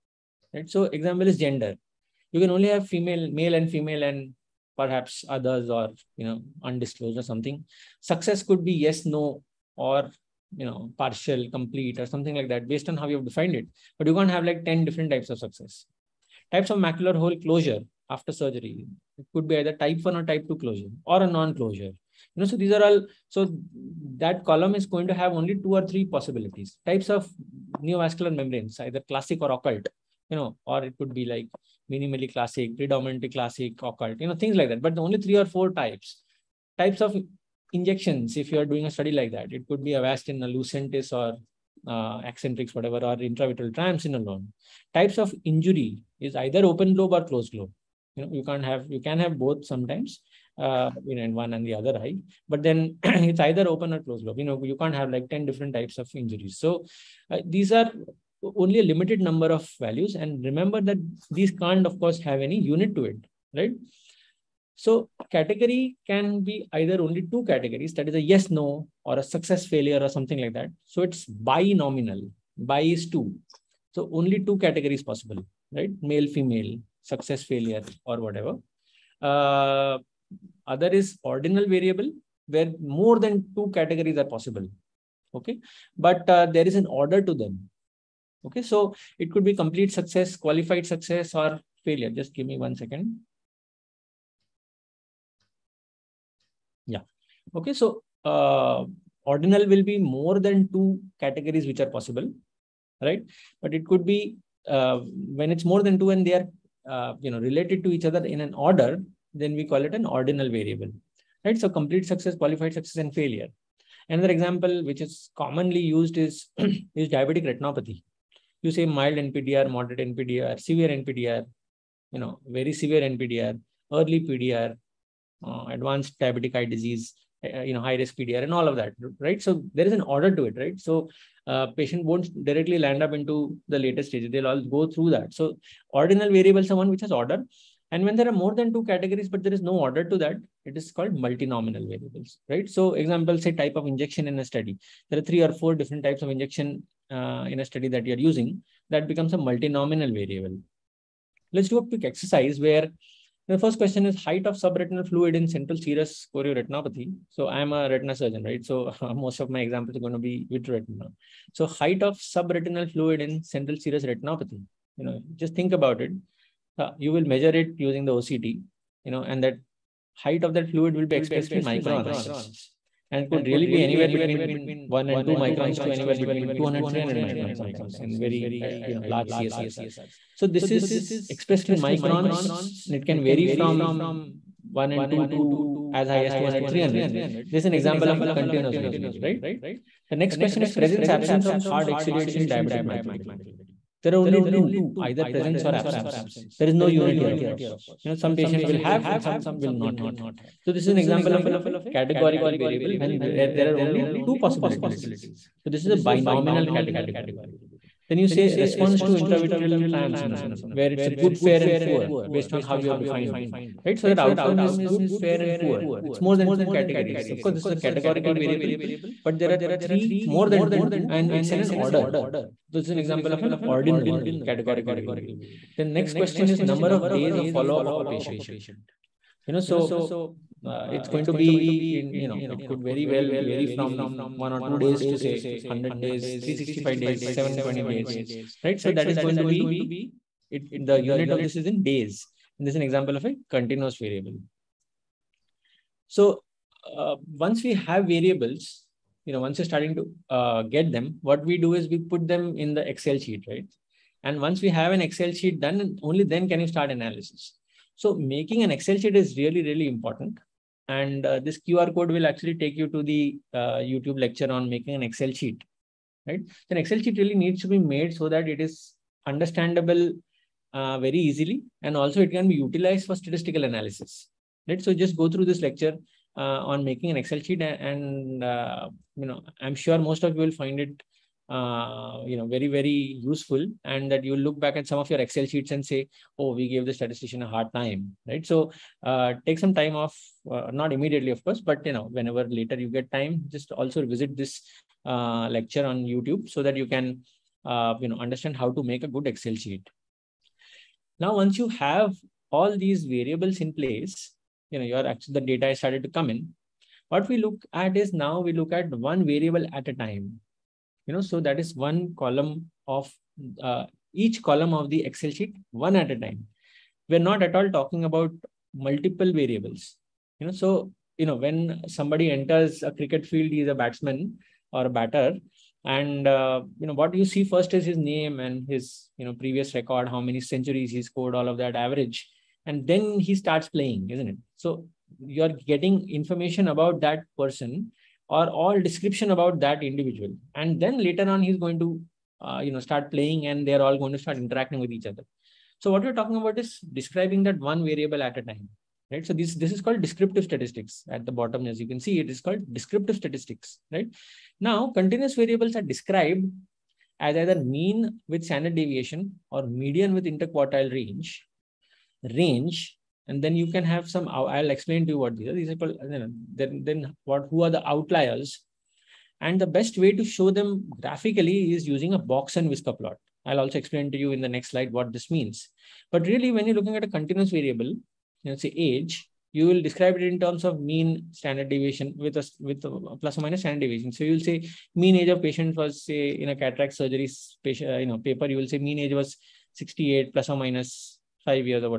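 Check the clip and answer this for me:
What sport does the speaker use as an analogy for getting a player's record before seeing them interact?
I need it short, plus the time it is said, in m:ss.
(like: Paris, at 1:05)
Cricket, at 5:23.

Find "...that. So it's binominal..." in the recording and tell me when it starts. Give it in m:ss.
1:10.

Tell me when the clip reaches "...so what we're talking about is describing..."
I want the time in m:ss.
5:45.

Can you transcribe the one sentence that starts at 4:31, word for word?
And also it can be utilized for statistical analysis, right?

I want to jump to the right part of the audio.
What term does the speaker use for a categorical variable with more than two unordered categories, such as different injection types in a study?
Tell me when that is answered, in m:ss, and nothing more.
2:21.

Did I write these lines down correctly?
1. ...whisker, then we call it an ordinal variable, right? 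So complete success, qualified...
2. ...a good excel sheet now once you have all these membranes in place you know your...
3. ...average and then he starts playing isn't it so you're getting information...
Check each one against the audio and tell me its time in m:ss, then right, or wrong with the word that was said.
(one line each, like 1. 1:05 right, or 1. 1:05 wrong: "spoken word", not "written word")
1. 1:48 wrong: "order", not "whisker"
2. 4:59 wrong: "variables", not "membranes"
3. 5:31 right.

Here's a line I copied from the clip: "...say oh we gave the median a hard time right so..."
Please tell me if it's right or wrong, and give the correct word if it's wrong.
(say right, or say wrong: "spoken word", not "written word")
wrong: "statistician", not "median".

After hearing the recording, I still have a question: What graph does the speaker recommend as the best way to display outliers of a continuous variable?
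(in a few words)
Box and whisker plot.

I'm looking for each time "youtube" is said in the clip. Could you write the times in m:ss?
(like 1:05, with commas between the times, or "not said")
4:23, 4:55.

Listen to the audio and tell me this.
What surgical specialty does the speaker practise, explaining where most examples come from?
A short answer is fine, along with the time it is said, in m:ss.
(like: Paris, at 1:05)
Retina surgeon, at 2:37.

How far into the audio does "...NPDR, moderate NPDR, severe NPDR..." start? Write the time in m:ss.
1:59.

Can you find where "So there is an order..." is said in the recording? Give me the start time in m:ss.
2:09.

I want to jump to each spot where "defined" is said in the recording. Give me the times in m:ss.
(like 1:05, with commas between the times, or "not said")
0:13, 3:32.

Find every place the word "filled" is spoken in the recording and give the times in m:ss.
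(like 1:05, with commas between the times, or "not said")
not said.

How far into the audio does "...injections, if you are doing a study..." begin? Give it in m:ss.
0:37.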